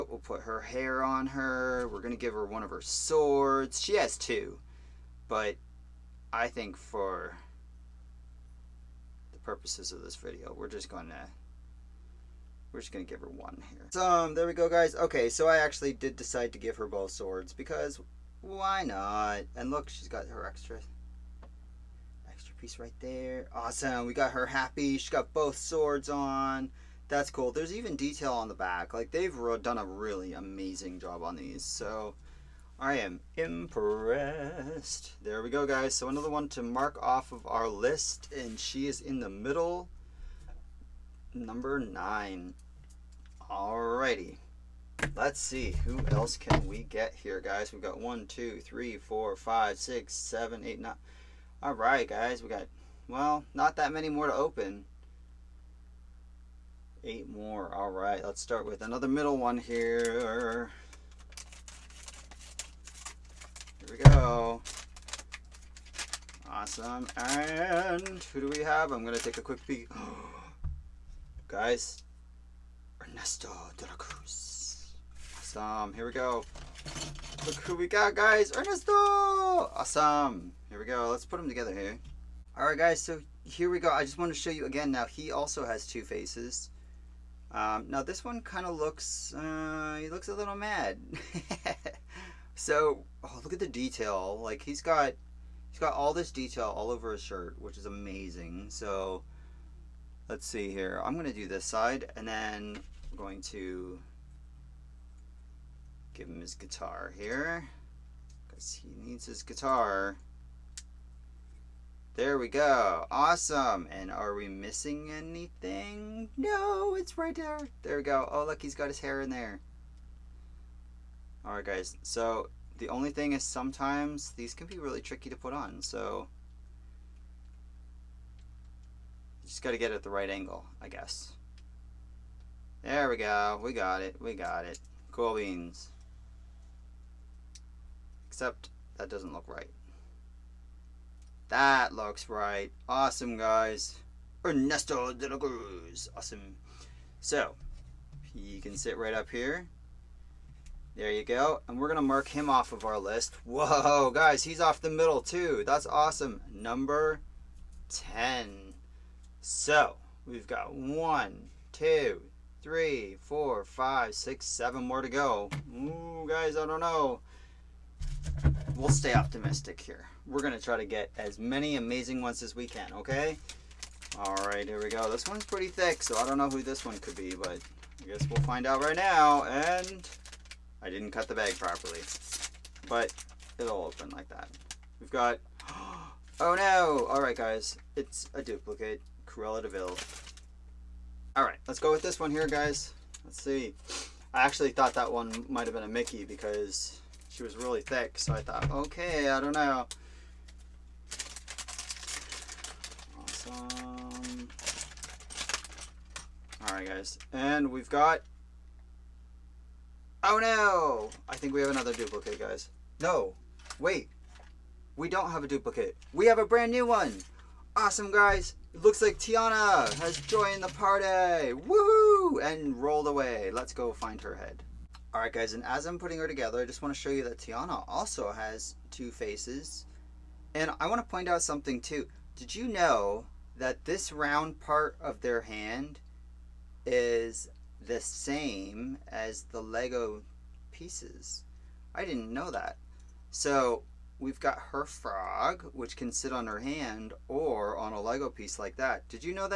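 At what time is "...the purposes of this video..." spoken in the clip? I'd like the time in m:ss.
0:09.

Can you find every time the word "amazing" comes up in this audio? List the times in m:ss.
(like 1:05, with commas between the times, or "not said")
0:30, 1:37, 2:51.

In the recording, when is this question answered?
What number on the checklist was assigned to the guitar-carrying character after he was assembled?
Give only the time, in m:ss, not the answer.
2:36.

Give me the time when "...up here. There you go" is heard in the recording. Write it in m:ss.
2:29.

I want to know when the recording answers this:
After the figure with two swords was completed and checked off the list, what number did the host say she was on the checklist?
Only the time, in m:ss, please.
0:41.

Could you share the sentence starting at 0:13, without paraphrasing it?
So, um, there we go, guys.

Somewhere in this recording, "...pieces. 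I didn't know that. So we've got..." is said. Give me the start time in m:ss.
4:00.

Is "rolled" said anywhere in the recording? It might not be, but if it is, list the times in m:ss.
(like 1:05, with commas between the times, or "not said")
3:42.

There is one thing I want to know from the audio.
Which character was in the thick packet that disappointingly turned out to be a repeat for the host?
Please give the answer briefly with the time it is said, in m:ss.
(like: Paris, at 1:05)
Cruella de Vil, at 3:09.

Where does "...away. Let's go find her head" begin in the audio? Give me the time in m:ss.
3:43.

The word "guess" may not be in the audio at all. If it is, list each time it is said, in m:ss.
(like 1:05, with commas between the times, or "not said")
2:10, 2:58.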